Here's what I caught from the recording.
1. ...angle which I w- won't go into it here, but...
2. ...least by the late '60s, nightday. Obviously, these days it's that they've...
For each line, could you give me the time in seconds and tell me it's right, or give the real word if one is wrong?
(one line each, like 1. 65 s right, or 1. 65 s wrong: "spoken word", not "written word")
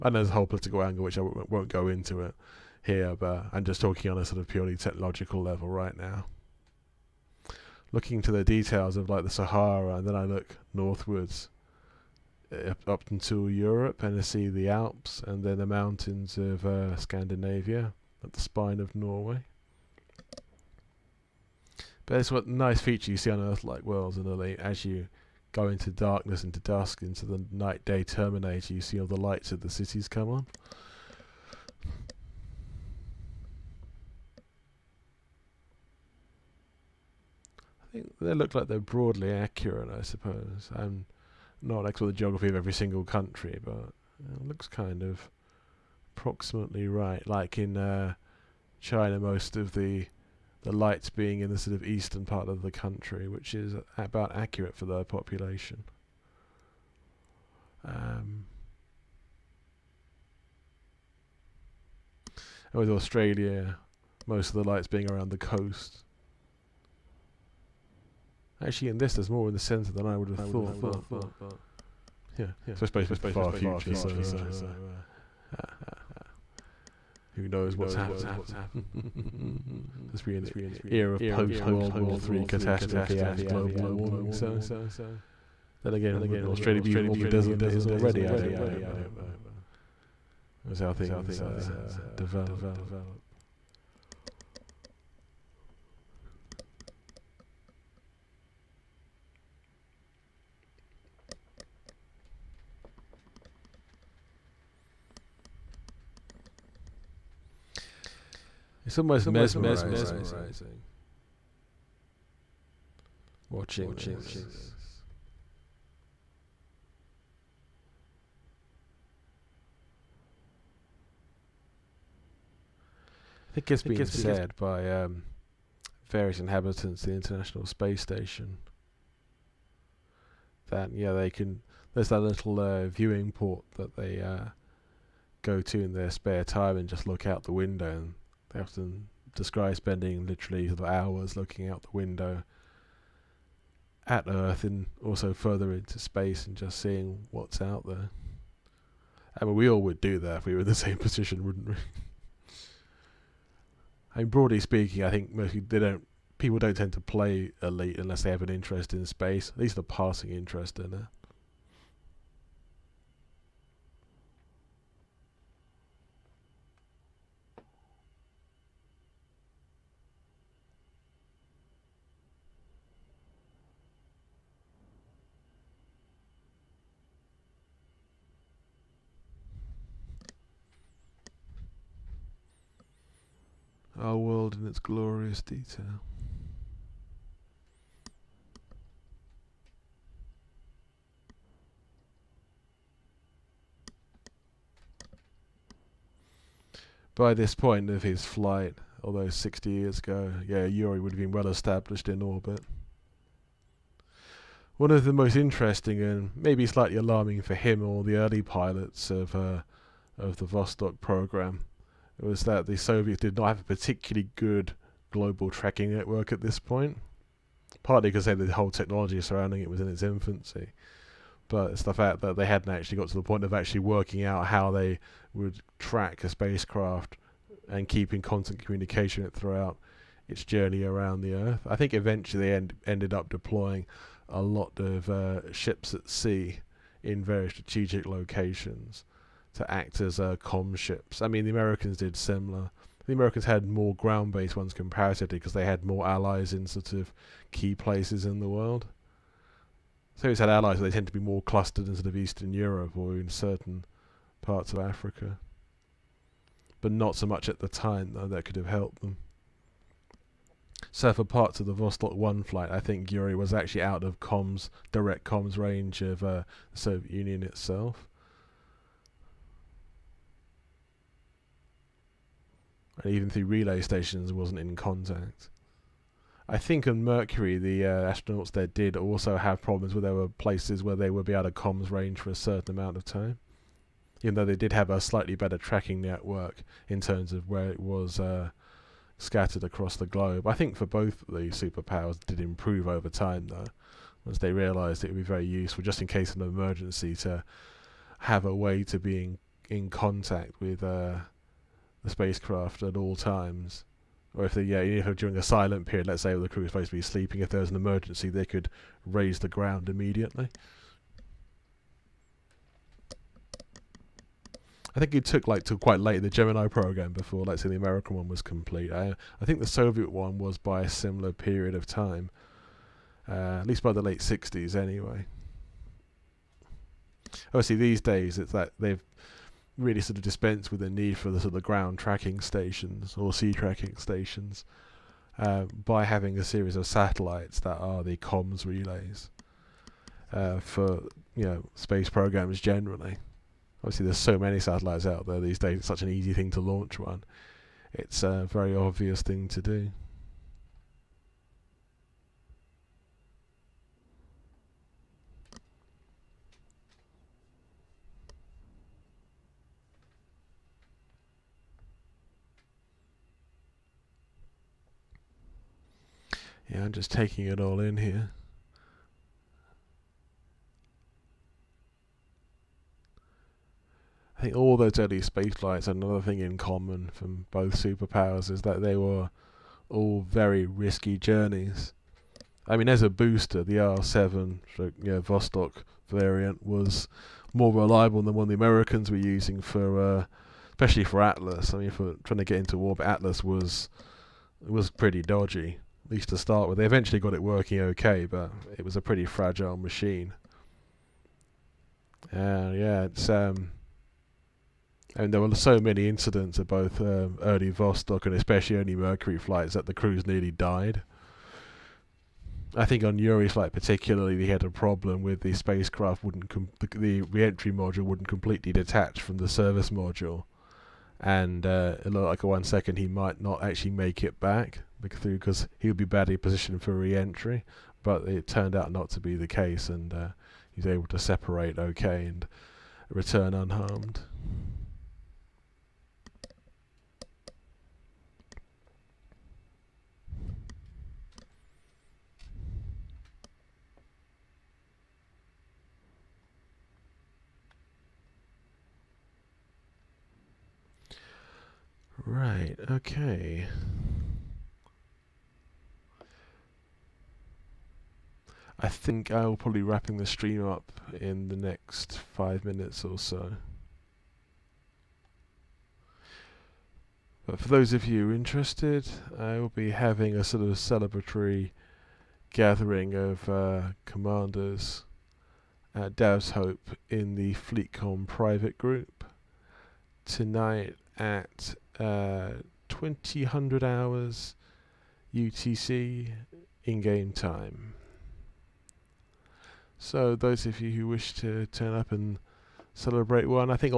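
1. 0 s right
2. 323 s wrong: "anyway", not "nightday".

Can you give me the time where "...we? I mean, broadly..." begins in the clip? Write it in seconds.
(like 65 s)
151 s.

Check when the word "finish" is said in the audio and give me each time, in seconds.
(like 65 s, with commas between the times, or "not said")
not said.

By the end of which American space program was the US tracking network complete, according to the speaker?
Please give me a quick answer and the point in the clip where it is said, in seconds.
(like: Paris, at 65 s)
Gemini, at 316 s.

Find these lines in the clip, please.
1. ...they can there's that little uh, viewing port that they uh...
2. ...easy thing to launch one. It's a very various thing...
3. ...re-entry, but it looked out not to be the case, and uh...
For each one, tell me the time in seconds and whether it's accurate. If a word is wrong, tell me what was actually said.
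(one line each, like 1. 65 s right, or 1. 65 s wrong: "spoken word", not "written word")
1. 131 s right
2. 346 s wrong: "obvious", not "various"
3. 426 s wrong: "turned", not "looked".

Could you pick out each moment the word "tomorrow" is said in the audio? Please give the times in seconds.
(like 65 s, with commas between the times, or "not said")
not said.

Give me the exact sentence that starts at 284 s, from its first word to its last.
Even though they did have a slightly better tracking network in terms of where it was uh, scattered across the globe.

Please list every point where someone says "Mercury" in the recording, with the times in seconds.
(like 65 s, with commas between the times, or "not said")
277 s, 408 s.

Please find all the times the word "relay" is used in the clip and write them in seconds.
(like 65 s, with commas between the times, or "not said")
273 s, 338 s.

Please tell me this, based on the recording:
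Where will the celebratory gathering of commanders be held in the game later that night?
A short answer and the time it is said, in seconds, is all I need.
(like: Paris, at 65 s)
Dav's Hope, at 476 s.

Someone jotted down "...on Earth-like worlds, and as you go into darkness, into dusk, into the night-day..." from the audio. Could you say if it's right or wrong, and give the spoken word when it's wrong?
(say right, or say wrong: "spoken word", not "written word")
right.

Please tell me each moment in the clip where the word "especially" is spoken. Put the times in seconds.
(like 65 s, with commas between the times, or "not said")
390 s, 408 s.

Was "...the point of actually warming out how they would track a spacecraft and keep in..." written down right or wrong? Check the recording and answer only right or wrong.
wrong.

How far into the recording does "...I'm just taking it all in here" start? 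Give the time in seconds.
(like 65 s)
366 s.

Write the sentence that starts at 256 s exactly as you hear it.
But not so much at the time, though, that could have helped them.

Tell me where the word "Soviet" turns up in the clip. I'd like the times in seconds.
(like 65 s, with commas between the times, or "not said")
212 s, 266 s, 319 s.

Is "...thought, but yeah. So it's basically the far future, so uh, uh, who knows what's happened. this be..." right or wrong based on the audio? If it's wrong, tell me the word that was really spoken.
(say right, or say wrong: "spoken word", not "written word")
right.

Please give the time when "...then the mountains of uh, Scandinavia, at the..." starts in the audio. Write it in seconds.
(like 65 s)
15 s.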